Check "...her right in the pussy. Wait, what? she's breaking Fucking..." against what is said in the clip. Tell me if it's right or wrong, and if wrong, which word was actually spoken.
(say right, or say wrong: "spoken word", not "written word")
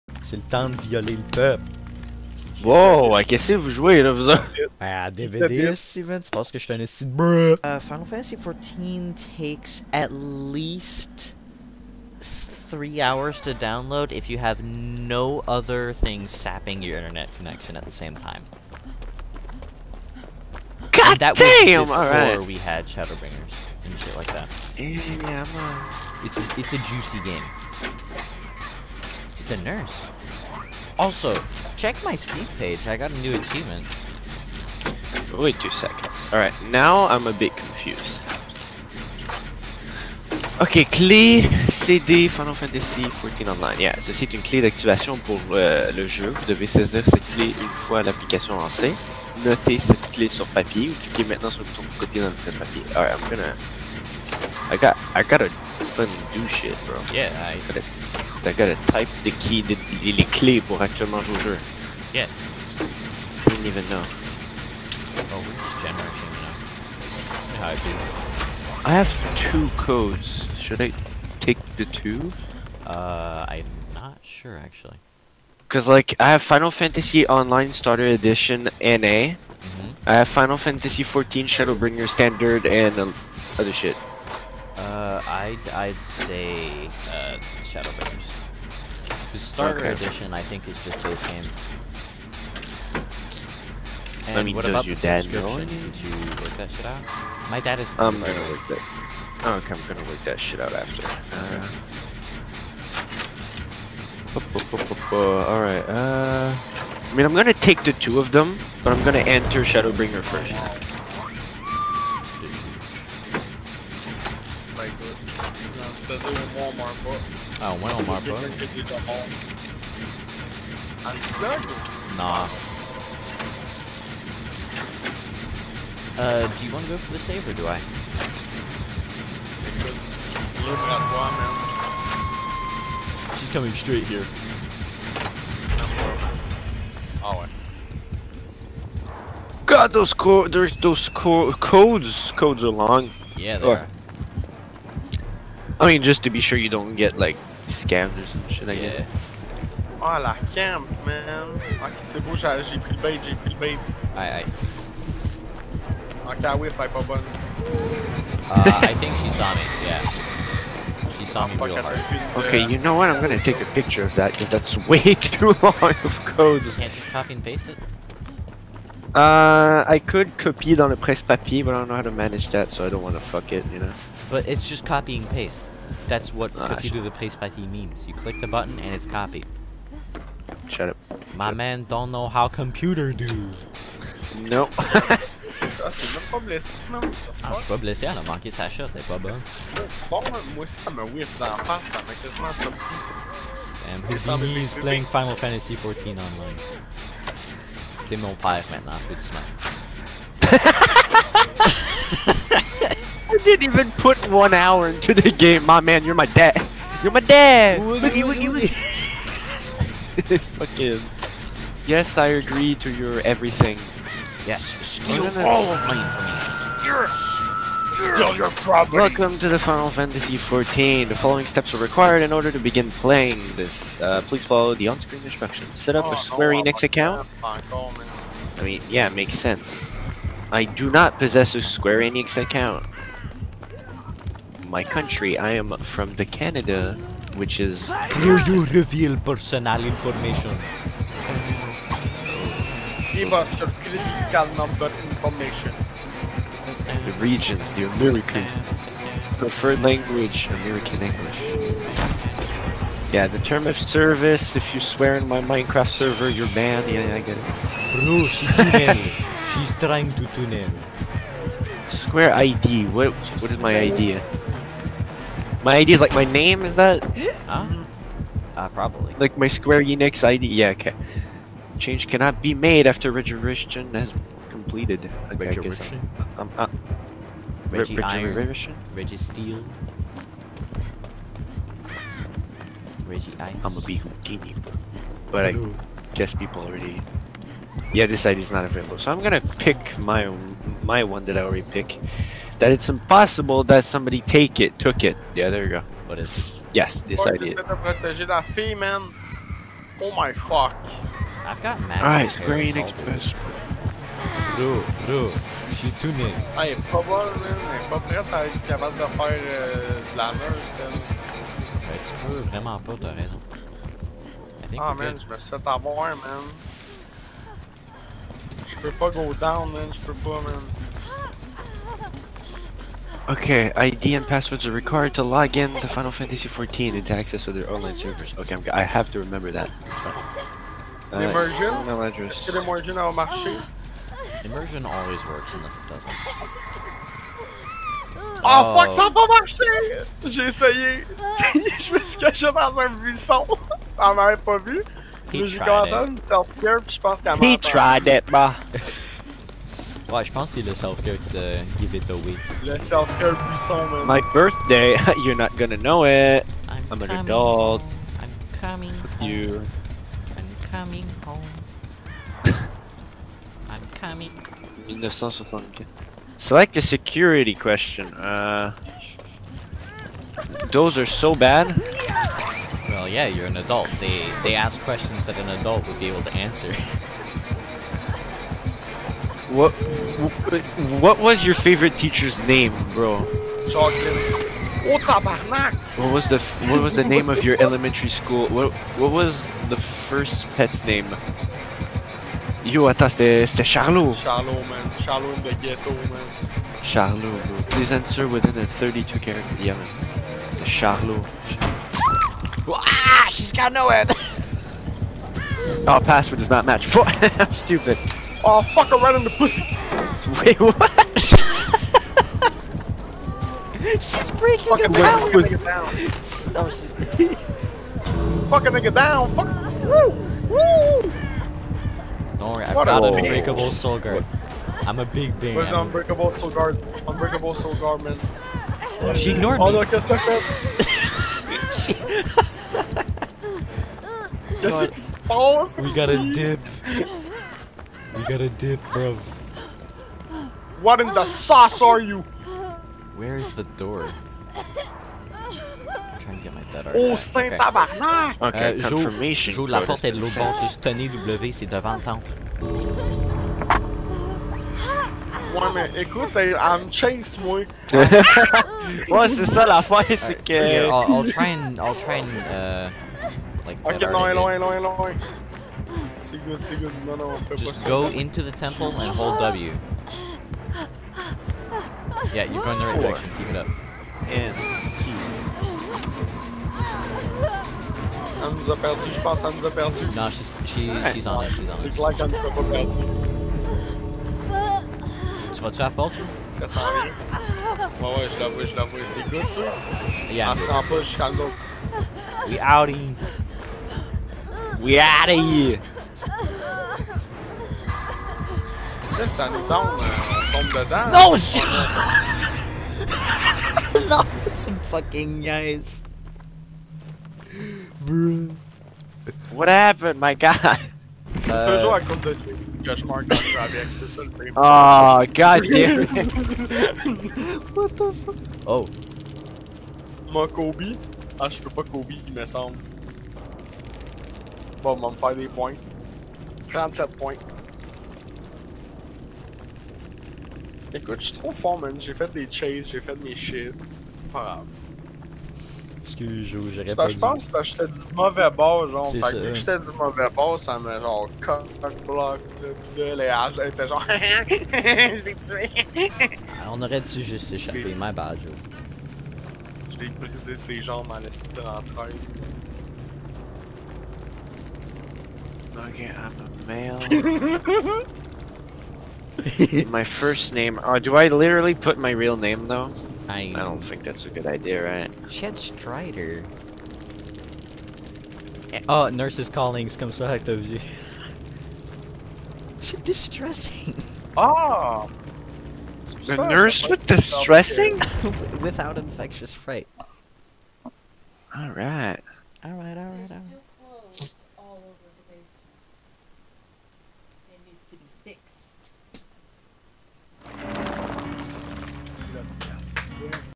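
right.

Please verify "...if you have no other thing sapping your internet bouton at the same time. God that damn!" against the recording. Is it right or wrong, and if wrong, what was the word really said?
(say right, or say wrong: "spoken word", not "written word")
wrong: "connection", not "bouton".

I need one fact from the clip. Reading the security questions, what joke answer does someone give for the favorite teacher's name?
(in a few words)
Chocolate.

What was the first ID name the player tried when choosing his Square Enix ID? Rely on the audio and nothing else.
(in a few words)
Reggie Iron.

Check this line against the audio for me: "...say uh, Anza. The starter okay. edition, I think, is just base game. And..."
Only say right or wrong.
wrong.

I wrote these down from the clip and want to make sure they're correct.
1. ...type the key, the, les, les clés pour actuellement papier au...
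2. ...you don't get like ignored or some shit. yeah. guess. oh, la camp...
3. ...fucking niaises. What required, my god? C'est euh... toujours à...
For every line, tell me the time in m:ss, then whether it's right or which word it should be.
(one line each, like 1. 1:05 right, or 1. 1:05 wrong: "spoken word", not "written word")
1. 0:58 wrong: "jouer", not "papier"
2. 2:26 wrong: "scammed", not "ignored"
3. 8:24 wrong: "happened", not "required".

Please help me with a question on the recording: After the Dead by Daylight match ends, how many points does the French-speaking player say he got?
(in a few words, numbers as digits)
37.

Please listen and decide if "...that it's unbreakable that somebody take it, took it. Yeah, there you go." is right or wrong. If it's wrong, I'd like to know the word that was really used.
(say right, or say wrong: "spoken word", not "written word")
wrong: "impossible", not "unbreakable".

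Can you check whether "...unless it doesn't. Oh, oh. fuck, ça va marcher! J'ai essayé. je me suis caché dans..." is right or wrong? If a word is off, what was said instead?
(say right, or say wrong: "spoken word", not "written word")
right.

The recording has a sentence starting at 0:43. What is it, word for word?
Yeah, ceci est une clé d'activation pour euh, le jeu.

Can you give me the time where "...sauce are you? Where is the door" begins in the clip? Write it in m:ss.
7:21.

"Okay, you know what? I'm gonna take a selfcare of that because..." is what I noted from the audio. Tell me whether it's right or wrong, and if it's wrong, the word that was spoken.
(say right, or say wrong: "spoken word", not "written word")
wrong: "picture", not "selfcare".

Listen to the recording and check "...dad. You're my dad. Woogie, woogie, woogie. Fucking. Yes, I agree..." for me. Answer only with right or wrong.
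right.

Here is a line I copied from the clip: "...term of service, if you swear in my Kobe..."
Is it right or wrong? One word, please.
wrong.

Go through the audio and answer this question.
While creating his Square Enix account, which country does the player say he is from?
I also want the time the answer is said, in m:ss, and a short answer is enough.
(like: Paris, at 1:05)
Canada, at 3:56.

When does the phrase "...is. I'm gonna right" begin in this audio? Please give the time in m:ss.
1:37.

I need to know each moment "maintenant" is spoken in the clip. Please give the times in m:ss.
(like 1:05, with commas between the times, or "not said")
0:51, 3:18.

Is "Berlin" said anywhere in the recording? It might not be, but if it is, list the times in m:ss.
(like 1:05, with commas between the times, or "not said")
not said.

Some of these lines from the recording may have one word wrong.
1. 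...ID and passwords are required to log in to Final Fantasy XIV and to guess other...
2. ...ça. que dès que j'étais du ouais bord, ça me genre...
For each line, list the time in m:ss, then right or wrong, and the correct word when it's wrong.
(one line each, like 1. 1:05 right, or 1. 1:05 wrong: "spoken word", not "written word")
1. 5:23 wrong: "access", not "guess"
2. 8:59 wrong: "mauvais", not "ouais".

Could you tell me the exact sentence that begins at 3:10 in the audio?
Bon, moi ça m'a whiff d'en face, ça m'a quasiment surpris.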